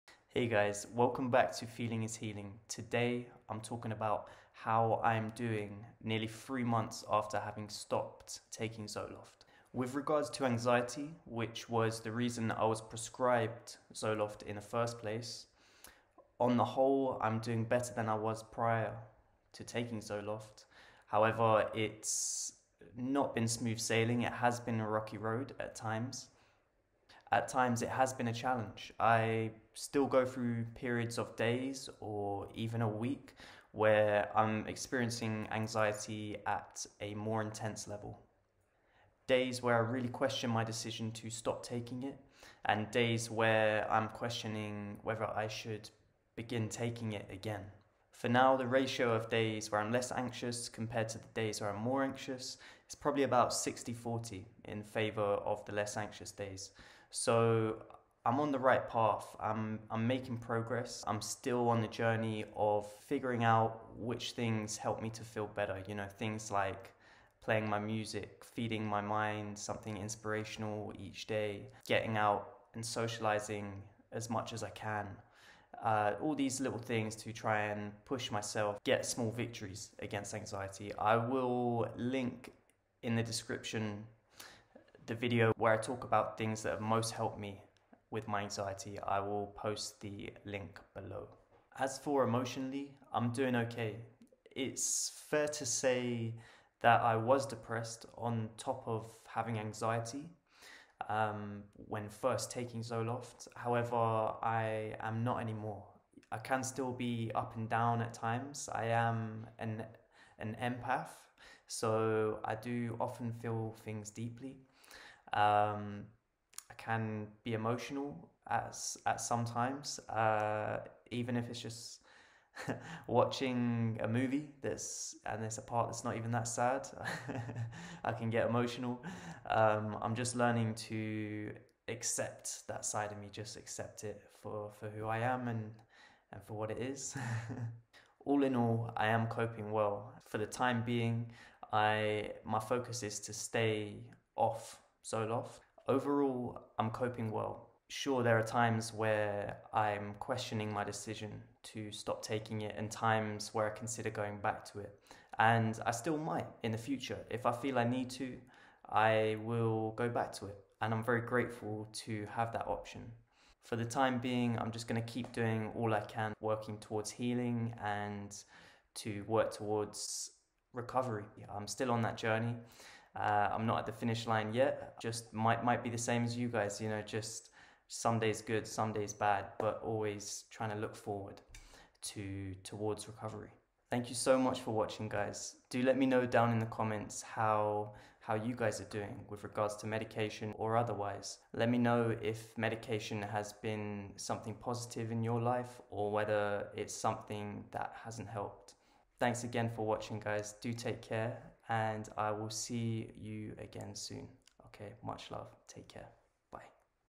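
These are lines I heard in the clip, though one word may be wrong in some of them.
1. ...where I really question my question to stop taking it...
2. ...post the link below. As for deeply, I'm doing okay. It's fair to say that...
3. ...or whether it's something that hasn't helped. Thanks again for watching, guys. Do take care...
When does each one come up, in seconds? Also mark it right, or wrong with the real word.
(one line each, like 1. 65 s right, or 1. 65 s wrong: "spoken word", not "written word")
1. 39 s wrong: "decision", not "question"
2. 89 s wrong: "emotionally", not "deeply"
3. 195 s right.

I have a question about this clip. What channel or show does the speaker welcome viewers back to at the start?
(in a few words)
Feeling is Healing.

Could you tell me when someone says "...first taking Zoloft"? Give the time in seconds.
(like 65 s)
102 s.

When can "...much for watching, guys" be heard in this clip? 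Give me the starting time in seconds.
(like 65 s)
184 s.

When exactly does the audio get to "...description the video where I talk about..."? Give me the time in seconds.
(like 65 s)
83 s.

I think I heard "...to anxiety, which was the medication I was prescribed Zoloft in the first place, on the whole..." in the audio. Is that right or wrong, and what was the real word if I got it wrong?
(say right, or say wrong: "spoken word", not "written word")
wrong: "reason", not "medication".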